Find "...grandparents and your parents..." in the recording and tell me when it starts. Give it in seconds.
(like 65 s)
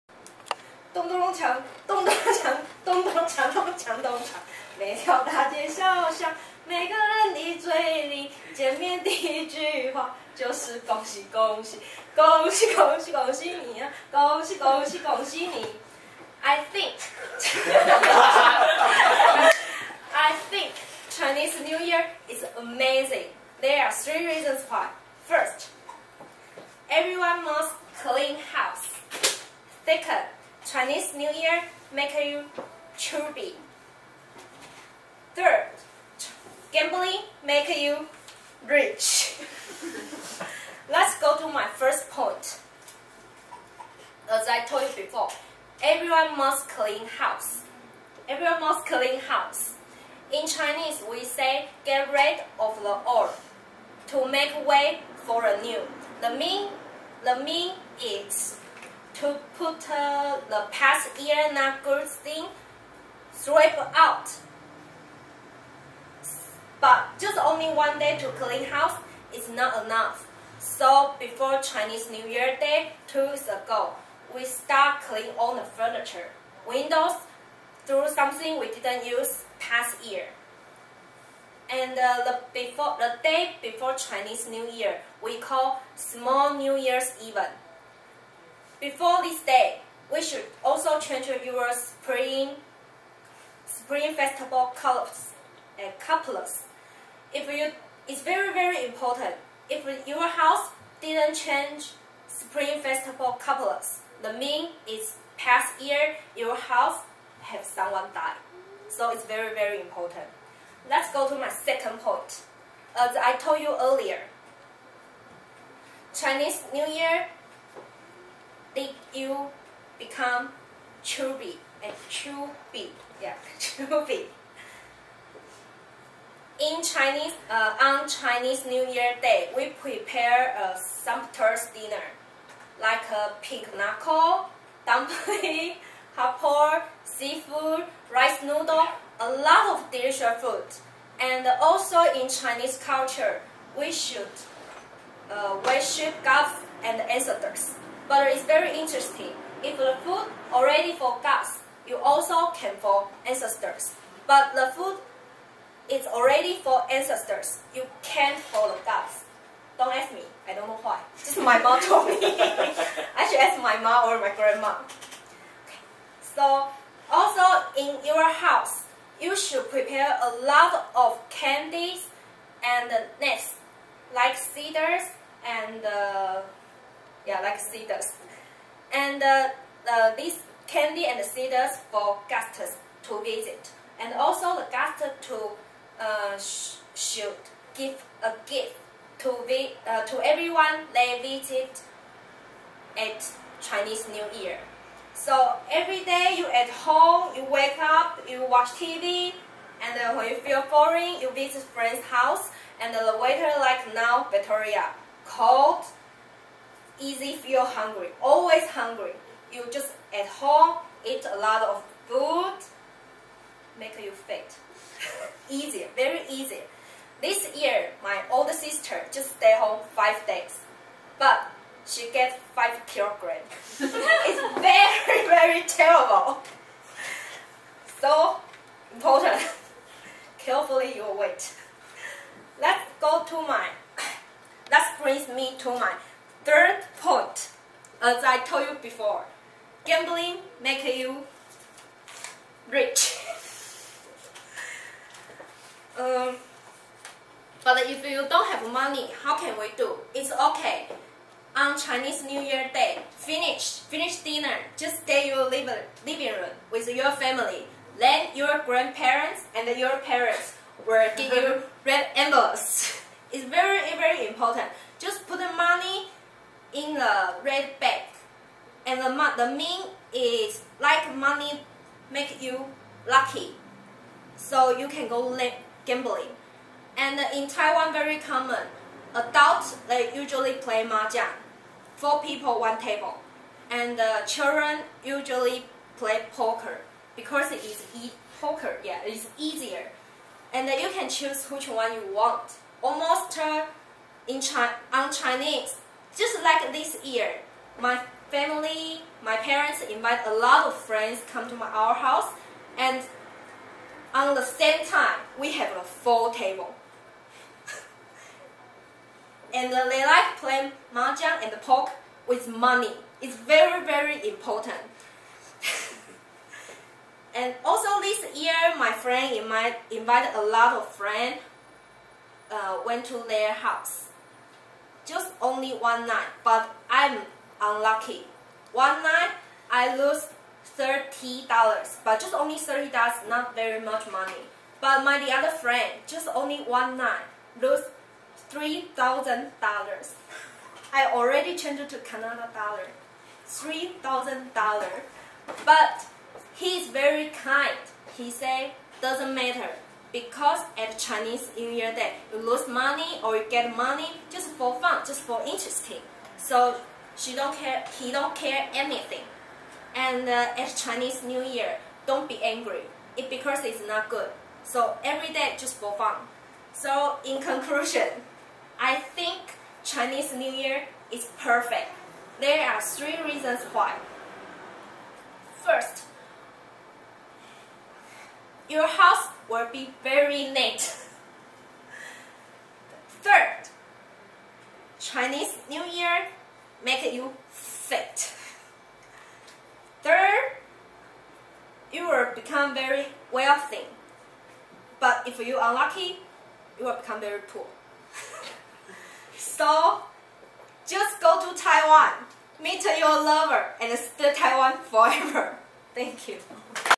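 258 s.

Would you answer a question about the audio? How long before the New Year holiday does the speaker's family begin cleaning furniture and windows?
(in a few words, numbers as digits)
2 weeks.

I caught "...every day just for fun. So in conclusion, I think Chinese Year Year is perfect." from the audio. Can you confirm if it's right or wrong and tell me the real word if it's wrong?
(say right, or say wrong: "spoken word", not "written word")
wrong: "New", not "Year".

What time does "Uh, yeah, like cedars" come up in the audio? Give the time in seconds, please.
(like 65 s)
175 s.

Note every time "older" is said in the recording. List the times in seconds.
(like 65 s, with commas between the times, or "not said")
218 s.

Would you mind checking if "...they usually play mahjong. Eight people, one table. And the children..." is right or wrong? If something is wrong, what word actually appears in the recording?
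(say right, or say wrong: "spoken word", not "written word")
wrong: "Four", not "Eight".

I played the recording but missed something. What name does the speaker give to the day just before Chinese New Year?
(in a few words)
small New Year's event.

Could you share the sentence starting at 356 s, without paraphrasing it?
So she don't care, he don't care anything.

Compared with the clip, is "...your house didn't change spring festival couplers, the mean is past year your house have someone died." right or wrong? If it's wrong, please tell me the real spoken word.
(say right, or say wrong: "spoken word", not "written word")
right.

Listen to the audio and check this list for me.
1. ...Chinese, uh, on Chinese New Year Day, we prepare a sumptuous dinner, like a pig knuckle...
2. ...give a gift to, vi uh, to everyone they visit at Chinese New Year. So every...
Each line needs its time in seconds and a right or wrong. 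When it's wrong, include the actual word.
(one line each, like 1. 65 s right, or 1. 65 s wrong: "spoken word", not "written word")
1. 126 s right
2. 187 s right.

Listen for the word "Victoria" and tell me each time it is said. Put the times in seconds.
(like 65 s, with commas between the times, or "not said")
204 s.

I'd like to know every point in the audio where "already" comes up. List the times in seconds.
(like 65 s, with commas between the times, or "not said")
150 s, 156 s, 341 s.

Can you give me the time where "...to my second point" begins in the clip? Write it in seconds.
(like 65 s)
111 s.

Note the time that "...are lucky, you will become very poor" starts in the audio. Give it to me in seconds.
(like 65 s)
395 s.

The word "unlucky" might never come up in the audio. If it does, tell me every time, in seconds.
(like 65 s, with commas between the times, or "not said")
327 s.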